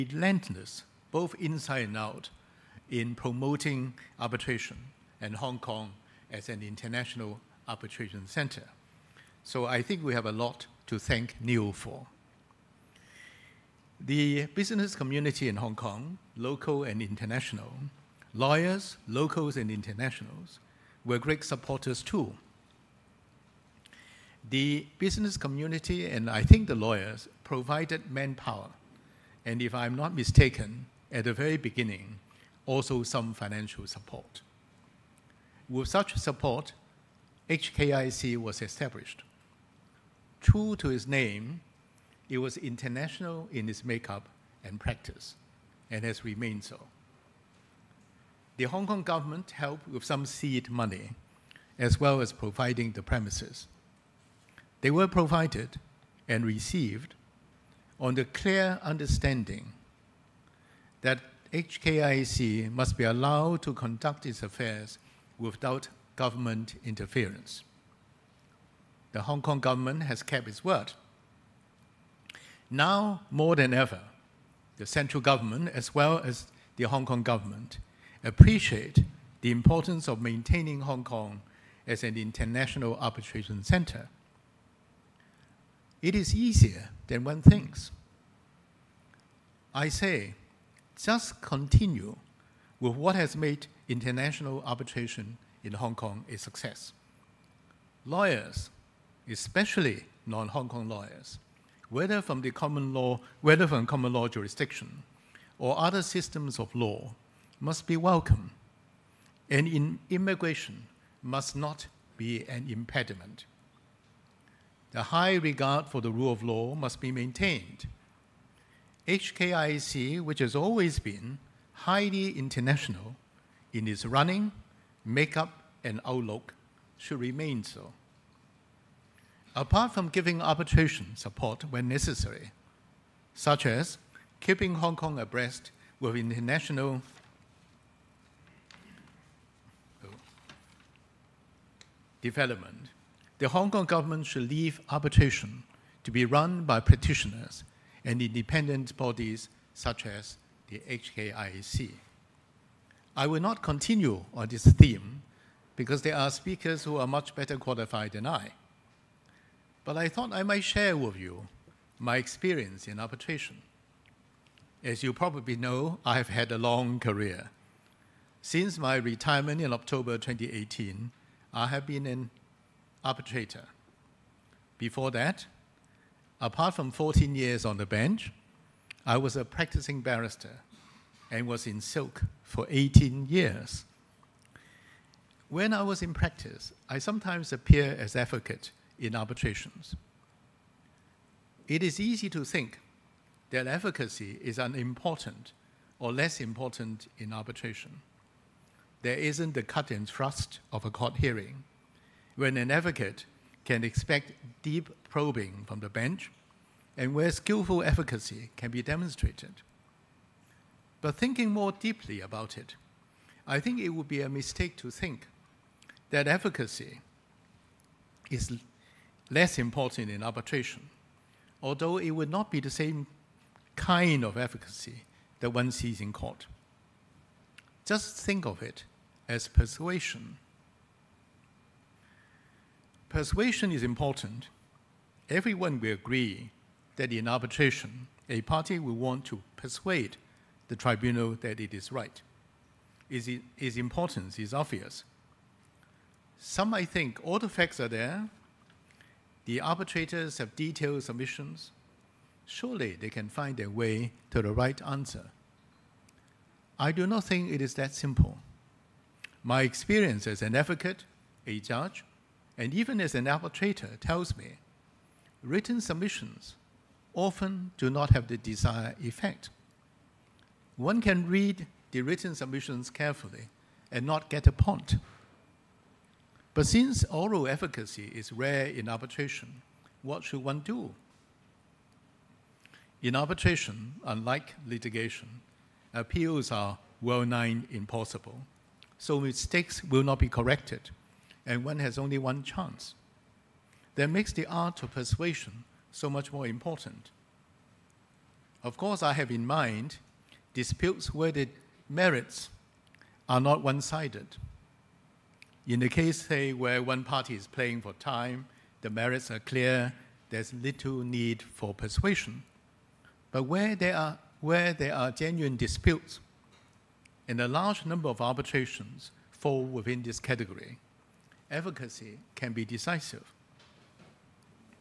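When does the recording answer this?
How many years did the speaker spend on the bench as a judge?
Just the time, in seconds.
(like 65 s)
176 s.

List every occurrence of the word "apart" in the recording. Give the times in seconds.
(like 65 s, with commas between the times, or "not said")
129 s, 176 s.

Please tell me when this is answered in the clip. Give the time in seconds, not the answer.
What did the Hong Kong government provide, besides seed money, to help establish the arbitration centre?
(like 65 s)
52 s.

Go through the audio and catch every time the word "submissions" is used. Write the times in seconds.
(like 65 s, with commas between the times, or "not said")
251 s, 265 s, 272 s.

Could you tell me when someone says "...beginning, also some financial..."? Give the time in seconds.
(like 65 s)
31 s.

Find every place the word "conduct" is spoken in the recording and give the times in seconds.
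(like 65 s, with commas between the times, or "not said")
63 s.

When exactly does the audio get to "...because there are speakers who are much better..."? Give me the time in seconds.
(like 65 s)
155 s.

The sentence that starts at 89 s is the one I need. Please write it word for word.
I say, just continue with what has made international arbitration in Hong Kong a success.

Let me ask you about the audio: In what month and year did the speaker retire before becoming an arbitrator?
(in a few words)
October 2018.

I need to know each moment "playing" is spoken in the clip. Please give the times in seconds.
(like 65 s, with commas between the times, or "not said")
307 s.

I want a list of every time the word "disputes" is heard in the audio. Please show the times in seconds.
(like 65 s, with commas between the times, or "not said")
300 s, 315 s.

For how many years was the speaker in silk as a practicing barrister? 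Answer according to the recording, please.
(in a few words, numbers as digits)
18.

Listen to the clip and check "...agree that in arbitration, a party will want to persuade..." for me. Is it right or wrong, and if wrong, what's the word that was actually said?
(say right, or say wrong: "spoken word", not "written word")
right.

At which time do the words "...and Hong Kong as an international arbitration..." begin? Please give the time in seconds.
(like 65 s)
5 s.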